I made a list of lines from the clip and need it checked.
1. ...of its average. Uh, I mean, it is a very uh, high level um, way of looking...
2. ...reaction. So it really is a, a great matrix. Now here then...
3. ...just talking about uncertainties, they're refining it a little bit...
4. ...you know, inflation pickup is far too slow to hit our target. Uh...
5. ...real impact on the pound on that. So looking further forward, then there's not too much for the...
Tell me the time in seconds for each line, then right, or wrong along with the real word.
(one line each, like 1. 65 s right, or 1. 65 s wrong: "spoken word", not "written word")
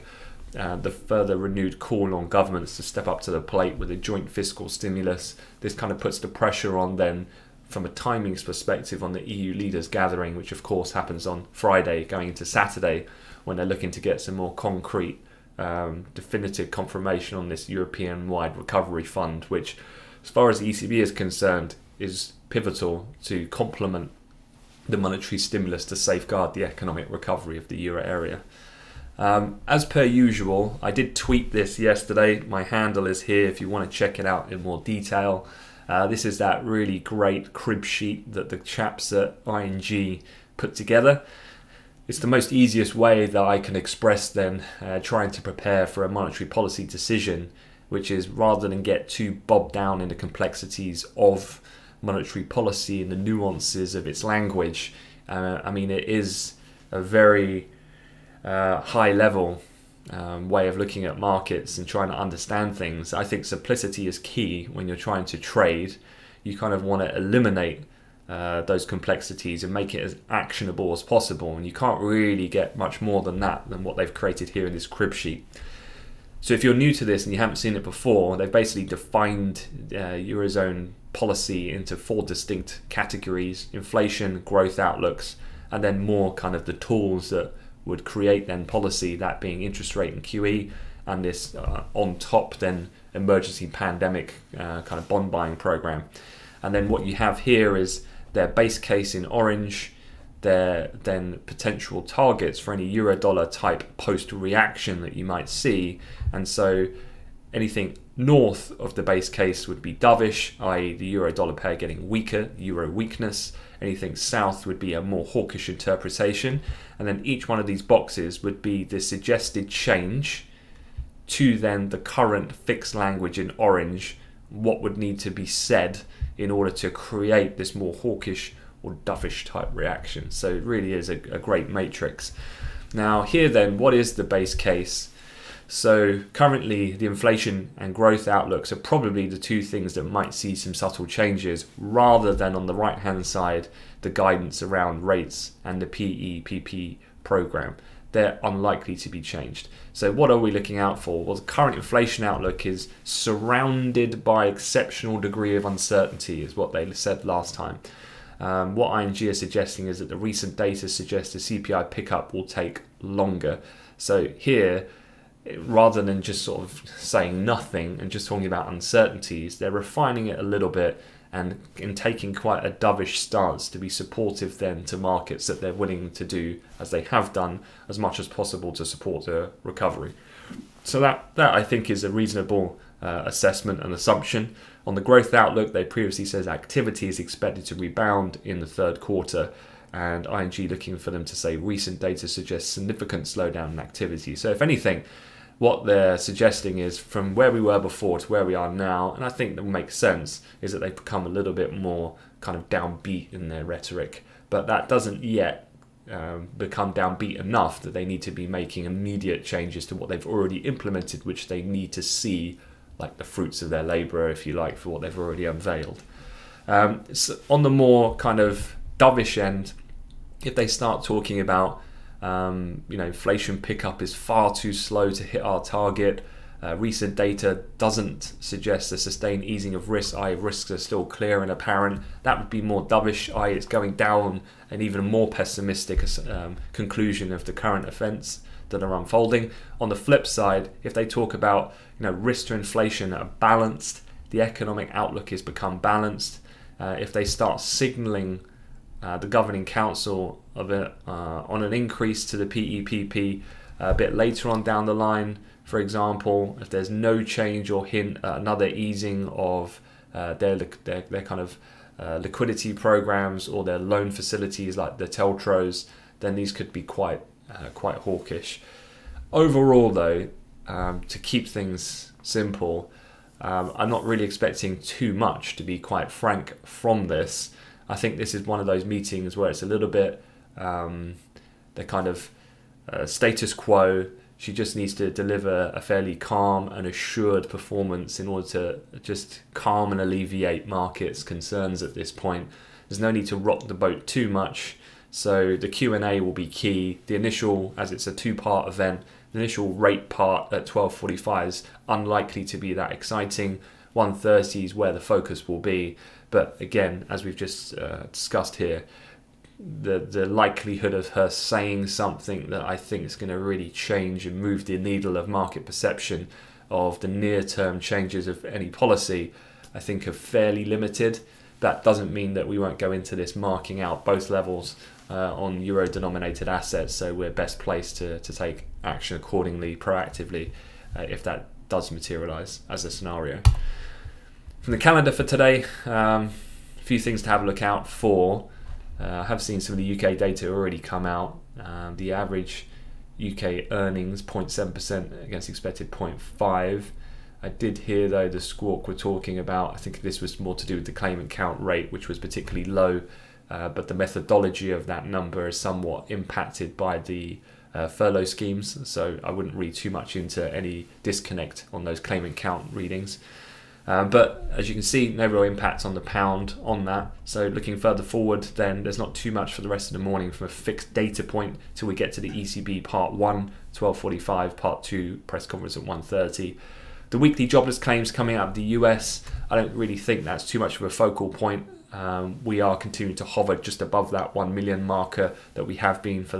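1. 53 s wrong: "language", not "average"
2. 129 s right
3. 168 s right
4. 222 s right
5. 365 s right.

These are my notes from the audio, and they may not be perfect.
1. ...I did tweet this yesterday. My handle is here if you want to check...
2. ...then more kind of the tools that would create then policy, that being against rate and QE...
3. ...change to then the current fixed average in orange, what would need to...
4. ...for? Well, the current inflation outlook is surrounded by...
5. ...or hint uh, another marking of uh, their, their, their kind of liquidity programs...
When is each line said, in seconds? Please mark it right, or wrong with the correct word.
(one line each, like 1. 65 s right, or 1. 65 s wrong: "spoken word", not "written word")
1. 30 s right
2. 85 s wrong: "interest", not "against"
3. 119 s wrong: "language", not "average"
4. 150 s right
5. 257 s wrong: "easing", not "marking".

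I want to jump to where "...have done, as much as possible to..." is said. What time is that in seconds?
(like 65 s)
177 s.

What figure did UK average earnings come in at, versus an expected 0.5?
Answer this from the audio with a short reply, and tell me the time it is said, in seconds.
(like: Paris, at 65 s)
0.7%, at 344 s.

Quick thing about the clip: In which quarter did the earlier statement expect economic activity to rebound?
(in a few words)
Third quarter.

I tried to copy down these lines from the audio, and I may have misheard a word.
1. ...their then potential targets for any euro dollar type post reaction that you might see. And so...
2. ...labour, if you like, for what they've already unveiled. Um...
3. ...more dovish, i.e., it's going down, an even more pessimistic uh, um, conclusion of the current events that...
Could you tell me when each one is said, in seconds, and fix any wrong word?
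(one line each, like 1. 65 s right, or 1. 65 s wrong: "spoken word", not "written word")
1. 100 s right
2. 213 s right
3. 232 s right.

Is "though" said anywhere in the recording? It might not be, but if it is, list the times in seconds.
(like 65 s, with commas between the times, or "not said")
269 s, 348 s.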